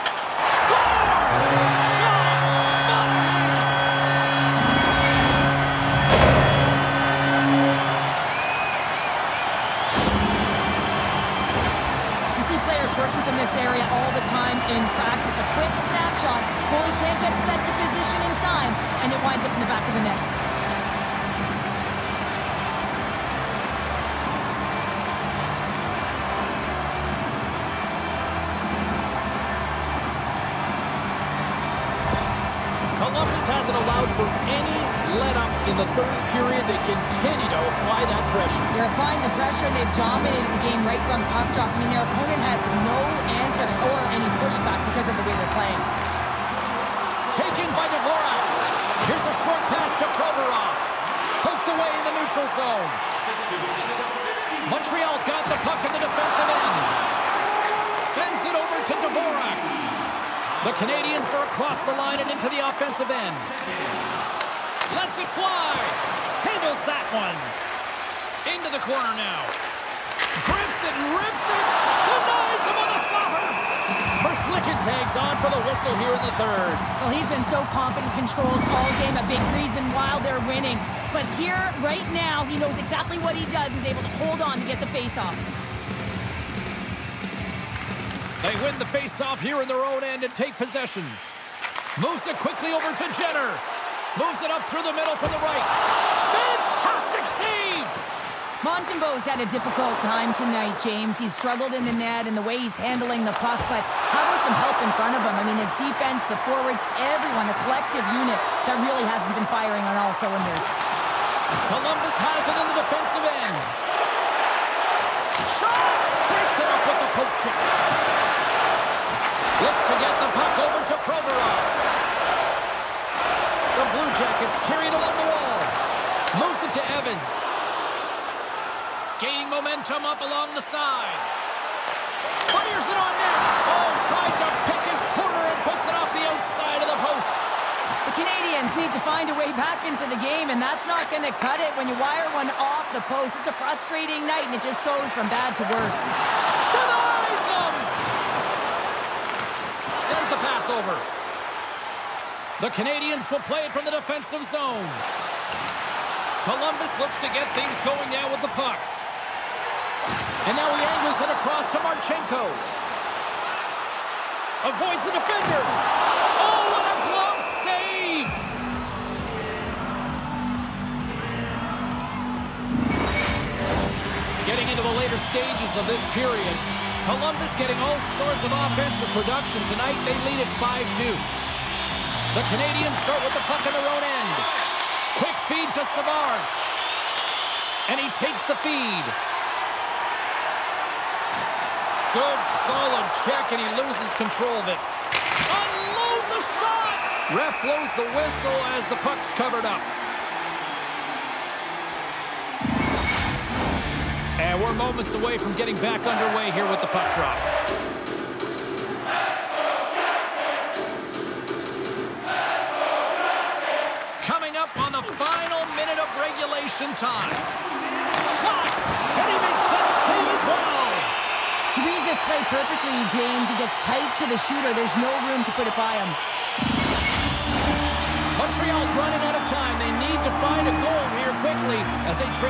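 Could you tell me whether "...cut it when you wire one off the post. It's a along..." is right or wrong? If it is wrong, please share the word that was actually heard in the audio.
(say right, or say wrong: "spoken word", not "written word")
wrong: "frustrating", not "along".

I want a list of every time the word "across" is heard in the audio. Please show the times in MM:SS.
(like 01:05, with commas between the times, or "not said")
01:01, 02:41.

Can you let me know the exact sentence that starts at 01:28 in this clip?
They win the face-off here in their own end and take possession.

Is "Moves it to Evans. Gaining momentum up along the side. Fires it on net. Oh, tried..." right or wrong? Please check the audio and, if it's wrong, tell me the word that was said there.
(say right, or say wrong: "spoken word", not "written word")
right.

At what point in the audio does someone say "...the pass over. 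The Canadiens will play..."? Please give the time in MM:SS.
02:30.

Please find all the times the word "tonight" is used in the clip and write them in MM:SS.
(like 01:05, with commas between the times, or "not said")
01:40, 02:59.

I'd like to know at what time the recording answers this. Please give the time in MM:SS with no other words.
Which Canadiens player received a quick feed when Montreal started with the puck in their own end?
03:05.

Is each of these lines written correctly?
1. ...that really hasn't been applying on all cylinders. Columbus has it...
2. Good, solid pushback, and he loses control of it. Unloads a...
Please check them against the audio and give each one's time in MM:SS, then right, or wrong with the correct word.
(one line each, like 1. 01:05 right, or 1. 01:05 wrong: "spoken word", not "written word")
1. 01:48 wrong: "firing", not "applying"
2. 03:12 wrong: "check", not "pushback".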